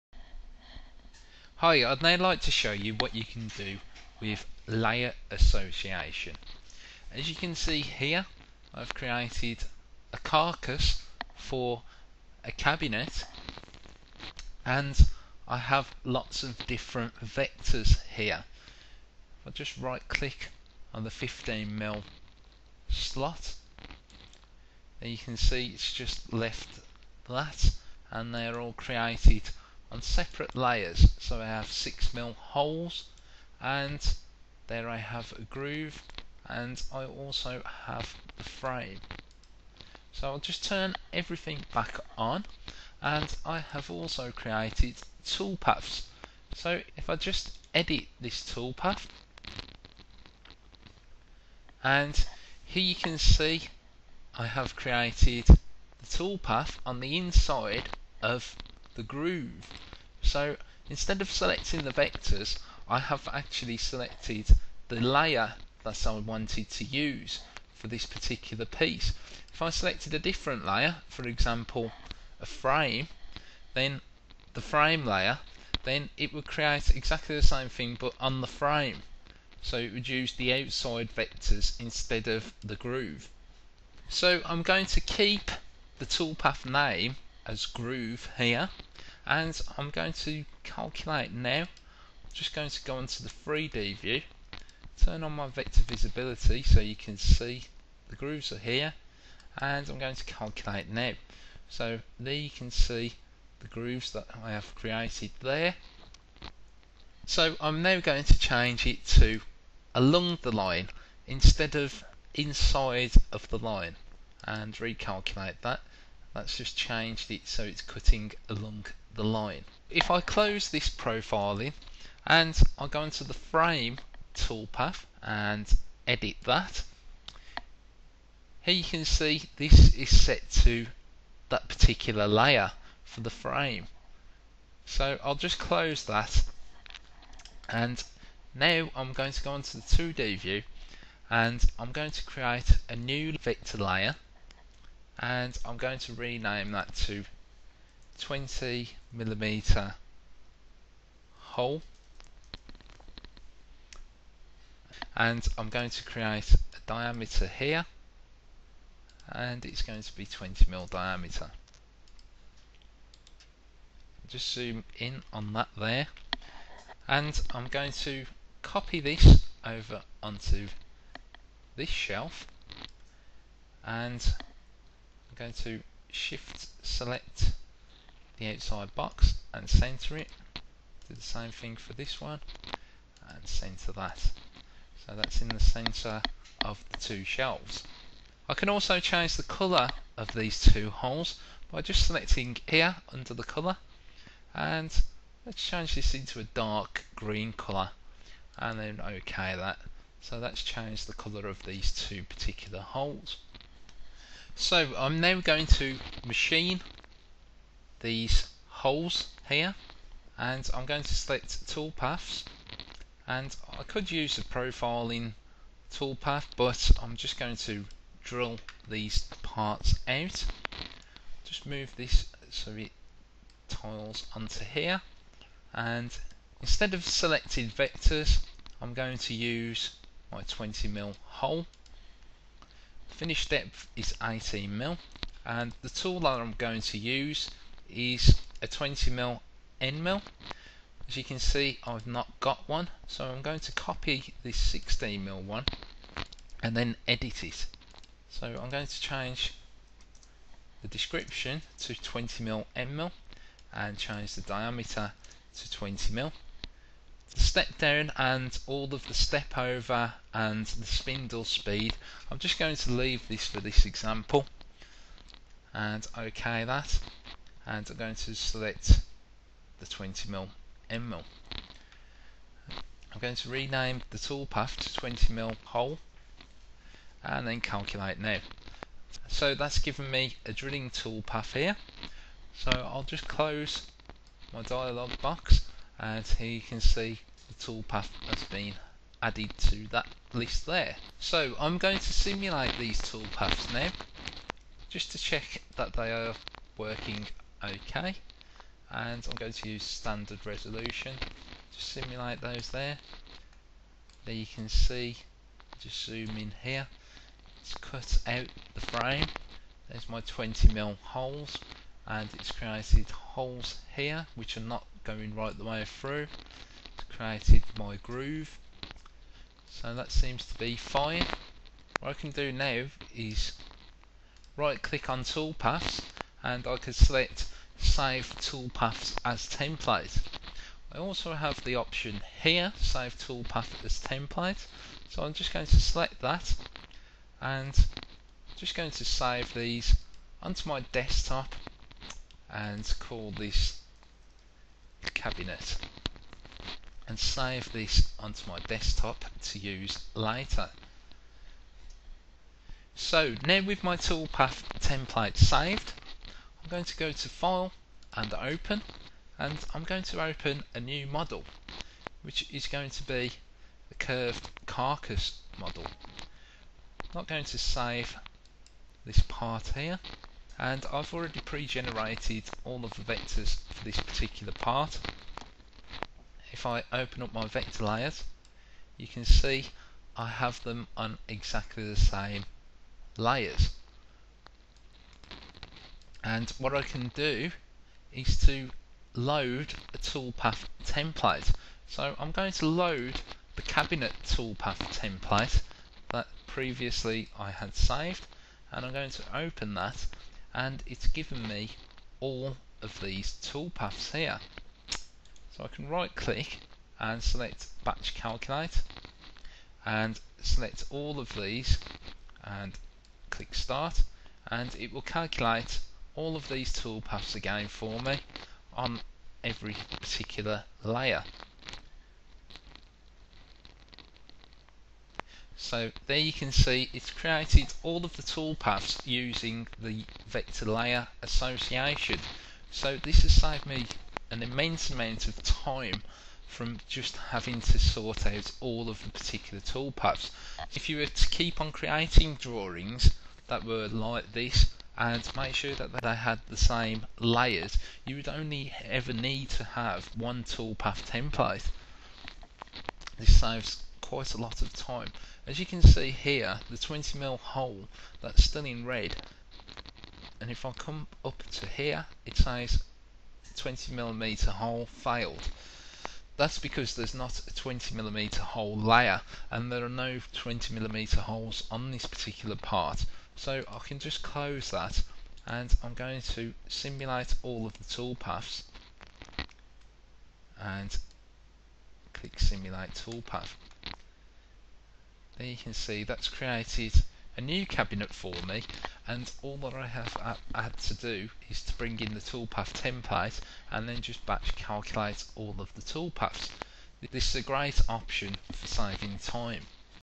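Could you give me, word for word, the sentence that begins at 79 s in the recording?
So it would use the outside vectors instead of the groove.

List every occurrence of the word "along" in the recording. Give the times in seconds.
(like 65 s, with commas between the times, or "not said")
109 s, 118 s.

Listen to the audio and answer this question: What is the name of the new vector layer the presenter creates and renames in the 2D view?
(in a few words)
20 millimeter hole.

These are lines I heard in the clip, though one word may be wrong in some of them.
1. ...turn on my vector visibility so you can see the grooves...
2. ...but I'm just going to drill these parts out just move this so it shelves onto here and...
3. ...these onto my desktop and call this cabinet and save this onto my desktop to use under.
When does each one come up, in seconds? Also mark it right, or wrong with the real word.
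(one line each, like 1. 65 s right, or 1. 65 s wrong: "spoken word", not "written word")
1. 95 s right
2. 216 s wrong: "tiles", not "shelves"
3. 339 s wrong: "later", not "under".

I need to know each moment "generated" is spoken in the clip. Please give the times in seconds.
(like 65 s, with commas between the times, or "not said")
371 s.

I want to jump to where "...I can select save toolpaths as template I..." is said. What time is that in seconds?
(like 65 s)
326 s.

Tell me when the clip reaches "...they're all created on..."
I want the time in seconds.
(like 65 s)
28 s.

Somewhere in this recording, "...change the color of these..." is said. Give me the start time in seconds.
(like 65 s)
188 s.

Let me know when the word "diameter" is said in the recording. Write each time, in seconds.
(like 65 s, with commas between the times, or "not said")
156 s, 160 s, 254 s.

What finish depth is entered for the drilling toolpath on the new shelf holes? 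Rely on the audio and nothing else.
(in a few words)
18mm.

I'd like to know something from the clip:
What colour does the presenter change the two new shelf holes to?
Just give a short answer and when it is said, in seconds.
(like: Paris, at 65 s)
dark green, at 196 s.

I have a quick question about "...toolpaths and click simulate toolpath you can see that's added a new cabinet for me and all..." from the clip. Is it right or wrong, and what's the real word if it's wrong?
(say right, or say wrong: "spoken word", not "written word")
wrong: "created", not "added".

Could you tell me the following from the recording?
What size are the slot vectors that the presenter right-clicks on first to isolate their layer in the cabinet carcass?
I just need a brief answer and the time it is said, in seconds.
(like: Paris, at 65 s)
15mm, at 21 s.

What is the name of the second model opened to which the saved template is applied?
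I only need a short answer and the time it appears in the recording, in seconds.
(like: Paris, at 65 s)
curved carcass, at 363 s.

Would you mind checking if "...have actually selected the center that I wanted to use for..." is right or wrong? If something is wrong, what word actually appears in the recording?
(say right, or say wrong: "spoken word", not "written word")
wrong: "layer", not "center".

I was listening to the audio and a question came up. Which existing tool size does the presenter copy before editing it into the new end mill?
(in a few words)
16mm.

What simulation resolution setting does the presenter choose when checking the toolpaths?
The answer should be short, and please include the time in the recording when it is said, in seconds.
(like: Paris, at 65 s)
standard resolution, at 299 s.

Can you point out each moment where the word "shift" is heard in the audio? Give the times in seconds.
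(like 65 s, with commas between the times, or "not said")
176 s.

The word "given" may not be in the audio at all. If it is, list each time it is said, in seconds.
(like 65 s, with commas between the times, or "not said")
279 s, 401 s.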